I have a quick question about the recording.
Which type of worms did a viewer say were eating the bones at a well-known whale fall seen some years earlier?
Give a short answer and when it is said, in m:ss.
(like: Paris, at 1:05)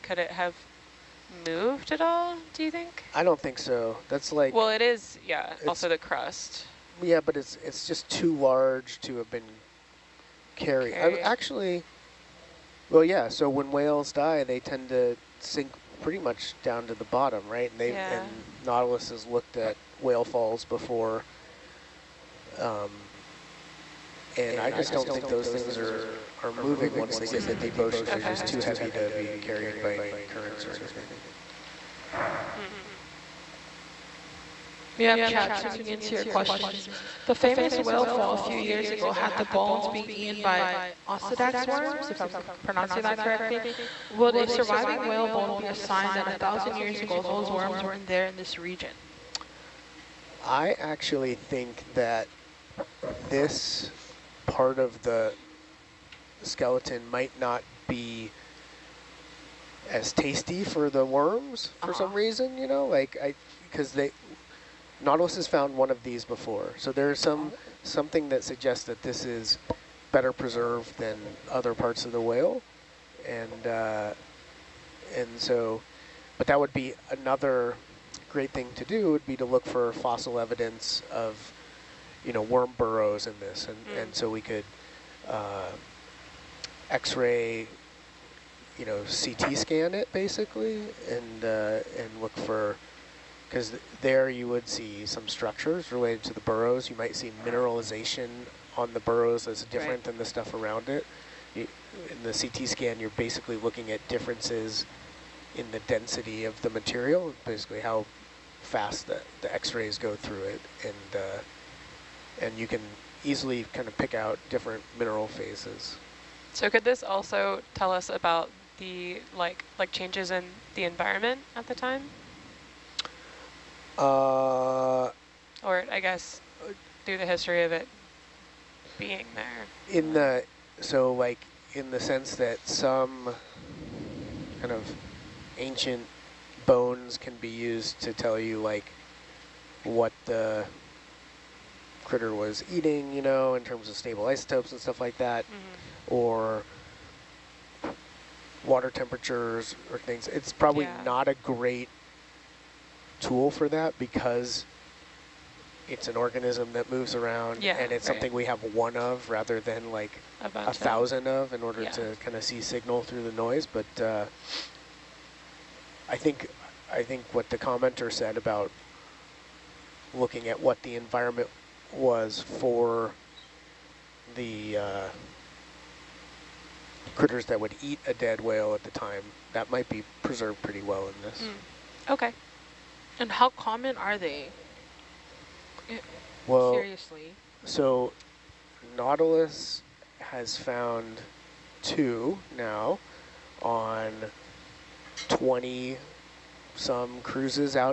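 Osedax worms, at 0:41.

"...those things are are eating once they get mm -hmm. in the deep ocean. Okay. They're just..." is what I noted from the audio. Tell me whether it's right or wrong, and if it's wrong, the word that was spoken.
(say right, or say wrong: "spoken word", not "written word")
wrong: "moving", not "eating".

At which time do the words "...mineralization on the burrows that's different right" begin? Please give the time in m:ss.
1:37.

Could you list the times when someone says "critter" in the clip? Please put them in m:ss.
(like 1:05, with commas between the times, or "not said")
2:22, 2:57.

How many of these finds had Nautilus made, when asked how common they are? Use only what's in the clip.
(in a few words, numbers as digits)
2.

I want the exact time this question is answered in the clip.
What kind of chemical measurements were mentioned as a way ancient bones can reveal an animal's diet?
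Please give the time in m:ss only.
2:23.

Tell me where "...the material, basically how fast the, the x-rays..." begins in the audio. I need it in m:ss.
1:46.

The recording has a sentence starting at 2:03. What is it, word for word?
Uh, or I guess through the history of it being there.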